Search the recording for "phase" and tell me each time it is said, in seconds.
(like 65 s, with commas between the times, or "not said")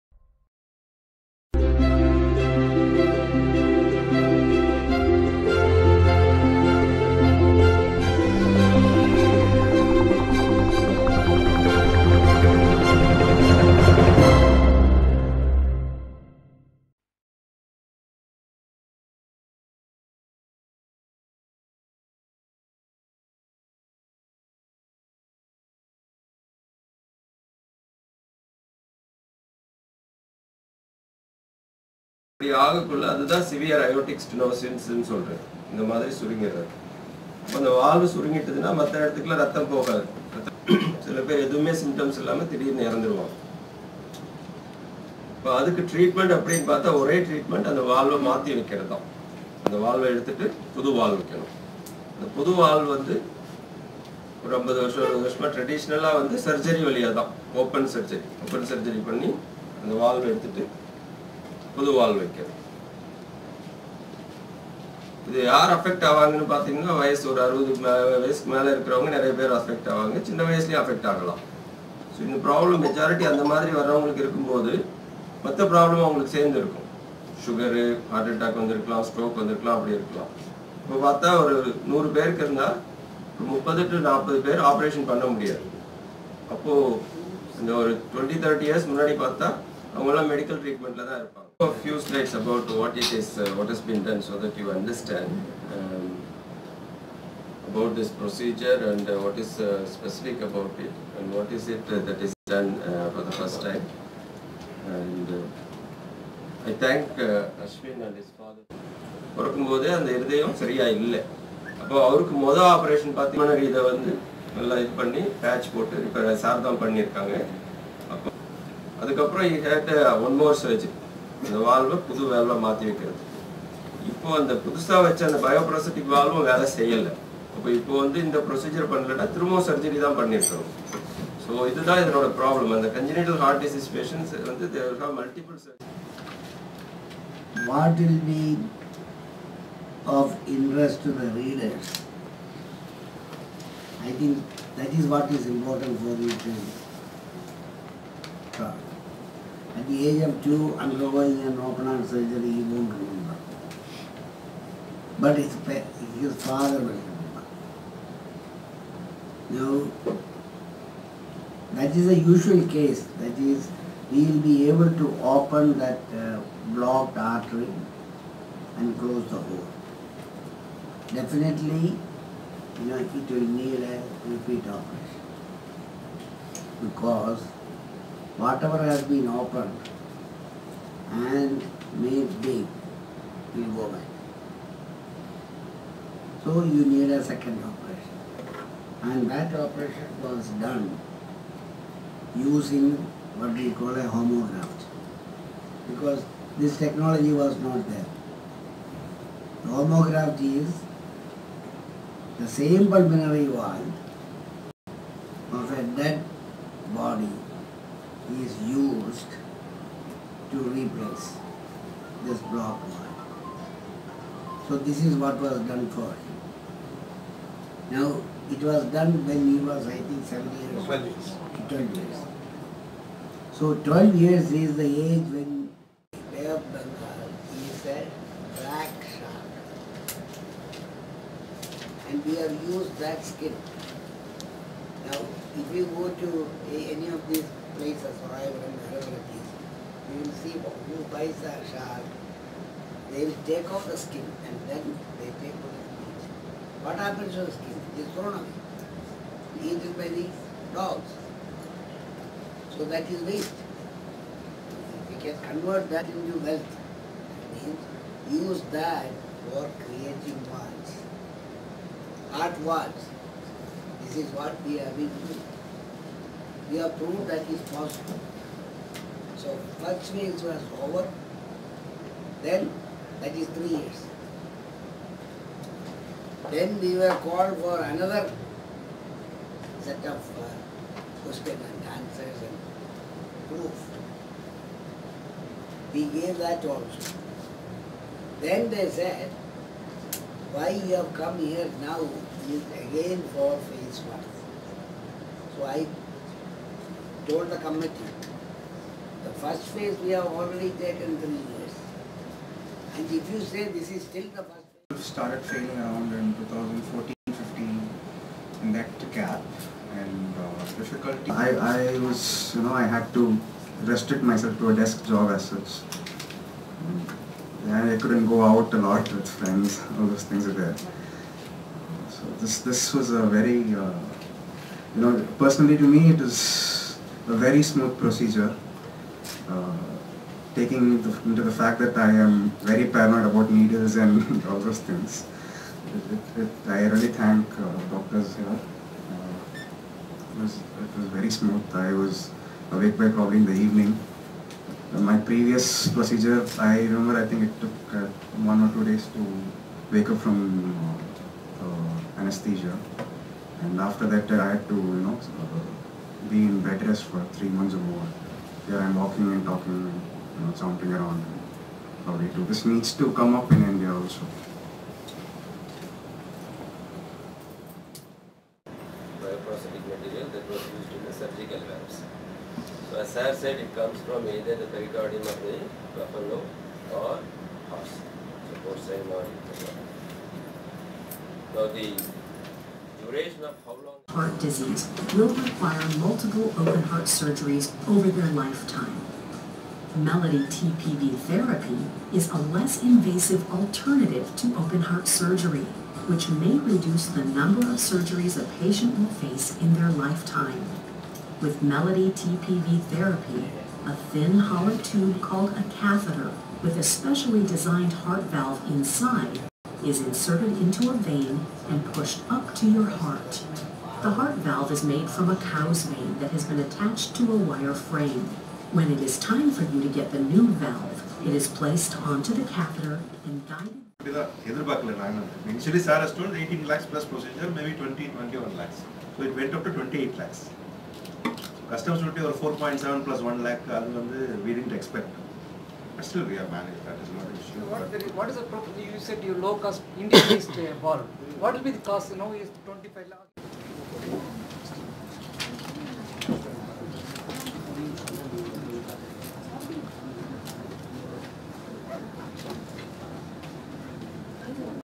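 293 s, 299 s, 304 s.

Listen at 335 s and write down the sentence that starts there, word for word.
It, it, it, I really thank uh, doctors here.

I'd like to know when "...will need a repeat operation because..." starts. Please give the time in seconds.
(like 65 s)
173 s.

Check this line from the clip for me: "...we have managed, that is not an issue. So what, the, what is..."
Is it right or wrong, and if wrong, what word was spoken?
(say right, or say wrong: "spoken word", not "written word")
right.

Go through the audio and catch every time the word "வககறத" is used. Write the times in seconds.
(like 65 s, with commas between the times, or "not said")
48 s, 62 s, 122 s.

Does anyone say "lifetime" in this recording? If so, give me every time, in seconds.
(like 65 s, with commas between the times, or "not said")
388 s, 399 s.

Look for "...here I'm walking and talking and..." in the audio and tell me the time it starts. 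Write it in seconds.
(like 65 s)
358 s.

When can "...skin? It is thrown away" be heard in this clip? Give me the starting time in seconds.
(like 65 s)
247 s.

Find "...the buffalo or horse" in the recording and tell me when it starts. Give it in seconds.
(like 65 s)
375 s.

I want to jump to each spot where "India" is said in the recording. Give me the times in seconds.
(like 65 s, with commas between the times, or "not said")
363 s, 439 s.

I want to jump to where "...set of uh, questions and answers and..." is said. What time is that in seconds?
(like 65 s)
279 s.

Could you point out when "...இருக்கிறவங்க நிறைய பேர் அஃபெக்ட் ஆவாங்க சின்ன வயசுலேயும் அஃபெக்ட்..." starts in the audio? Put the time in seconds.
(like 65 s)
68 s.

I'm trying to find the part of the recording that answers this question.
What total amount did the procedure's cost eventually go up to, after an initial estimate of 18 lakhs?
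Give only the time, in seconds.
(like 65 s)
429 s.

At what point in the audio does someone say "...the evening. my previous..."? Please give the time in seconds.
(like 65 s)
343 s.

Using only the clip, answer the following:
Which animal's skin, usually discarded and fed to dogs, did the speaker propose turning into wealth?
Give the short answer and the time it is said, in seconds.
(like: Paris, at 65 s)
black shark, at 228 s.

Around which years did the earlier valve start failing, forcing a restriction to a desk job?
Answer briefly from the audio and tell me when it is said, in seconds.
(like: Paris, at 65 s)
2014-15, at 306 s.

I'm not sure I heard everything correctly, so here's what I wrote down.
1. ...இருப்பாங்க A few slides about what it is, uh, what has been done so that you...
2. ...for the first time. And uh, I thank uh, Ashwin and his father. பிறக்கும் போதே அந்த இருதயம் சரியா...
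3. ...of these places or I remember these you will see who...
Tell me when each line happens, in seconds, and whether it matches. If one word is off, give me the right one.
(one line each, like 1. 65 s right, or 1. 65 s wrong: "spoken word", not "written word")
1. 91 s right
2. 103 s right
3. 237 s right.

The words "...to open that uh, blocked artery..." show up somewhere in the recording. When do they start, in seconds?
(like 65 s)
164 s.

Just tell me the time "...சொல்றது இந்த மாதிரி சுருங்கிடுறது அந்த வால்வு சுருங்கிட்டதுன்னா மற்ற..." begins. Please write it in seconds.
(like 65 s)
35 s.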